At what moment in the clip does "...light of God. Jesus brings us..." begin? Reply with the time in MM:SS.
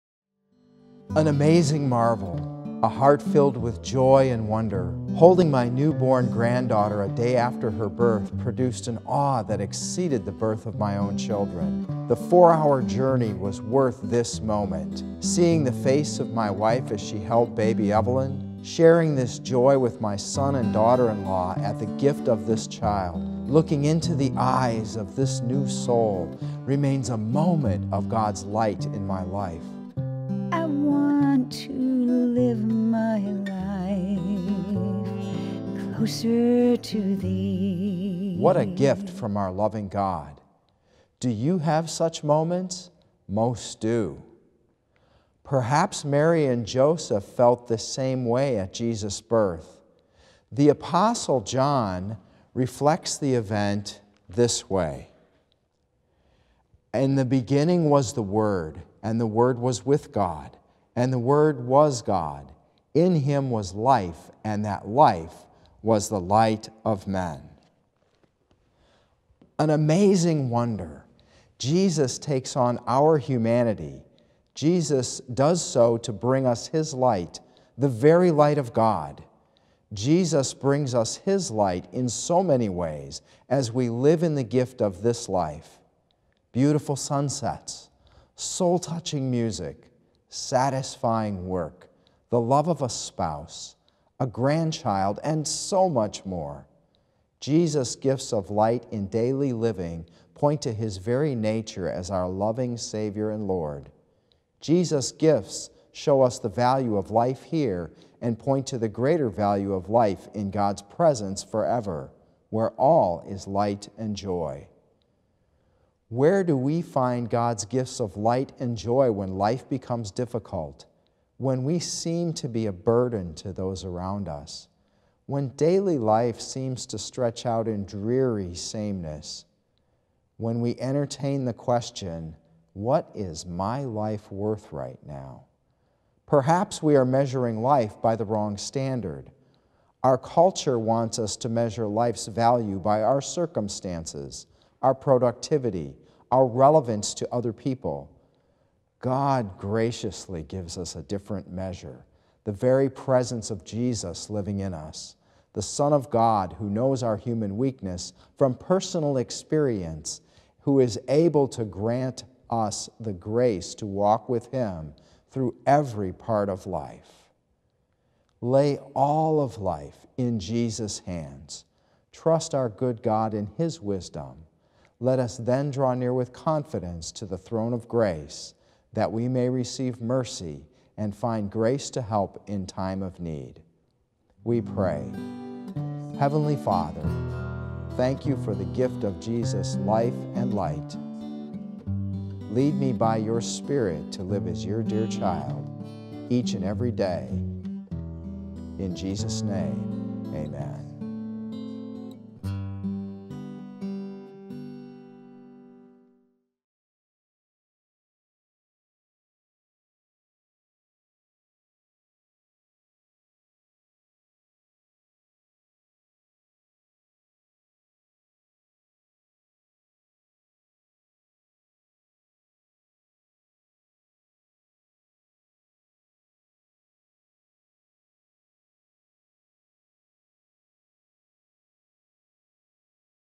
01:18.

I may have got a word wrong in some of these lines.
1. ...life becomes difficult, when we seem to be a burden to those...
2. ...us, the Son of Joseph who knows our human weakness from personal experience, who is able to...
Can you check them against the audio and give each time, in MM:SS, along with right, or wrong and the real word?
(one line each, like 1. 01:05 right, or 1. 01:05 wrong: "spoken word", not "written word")
1. 01:59 right
2. 02:34 wrong: "God", not "Joseph".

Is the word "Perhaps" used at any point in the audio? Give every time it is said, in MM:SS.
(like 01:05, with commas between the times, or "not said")
00:45, 02:16.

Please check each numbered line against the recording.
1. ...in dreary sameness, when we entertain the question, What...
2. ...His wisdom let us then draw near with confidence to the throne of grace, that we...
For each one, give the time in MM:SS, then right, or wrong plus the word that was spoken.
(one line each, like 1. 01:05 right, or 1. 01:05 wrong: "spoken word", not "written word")
1. 02:07 right
2. 02:53 right.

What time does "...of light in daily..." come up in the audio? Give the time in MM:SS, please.
01:38.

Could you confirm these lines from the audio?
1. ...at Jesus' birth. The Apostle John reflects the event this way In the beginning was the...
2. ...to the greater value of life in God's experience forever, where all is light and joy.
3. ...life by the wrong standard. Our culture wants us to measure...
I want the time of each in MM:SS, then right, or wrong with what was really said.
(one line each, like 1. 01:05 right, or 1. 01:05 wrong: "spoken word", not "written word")
1. 00:48 right
2. 01:48 wrong: "presence", not "experience"
3. 02:17 right.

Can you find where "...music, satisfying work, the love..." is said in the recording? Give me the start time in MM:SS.
01:29.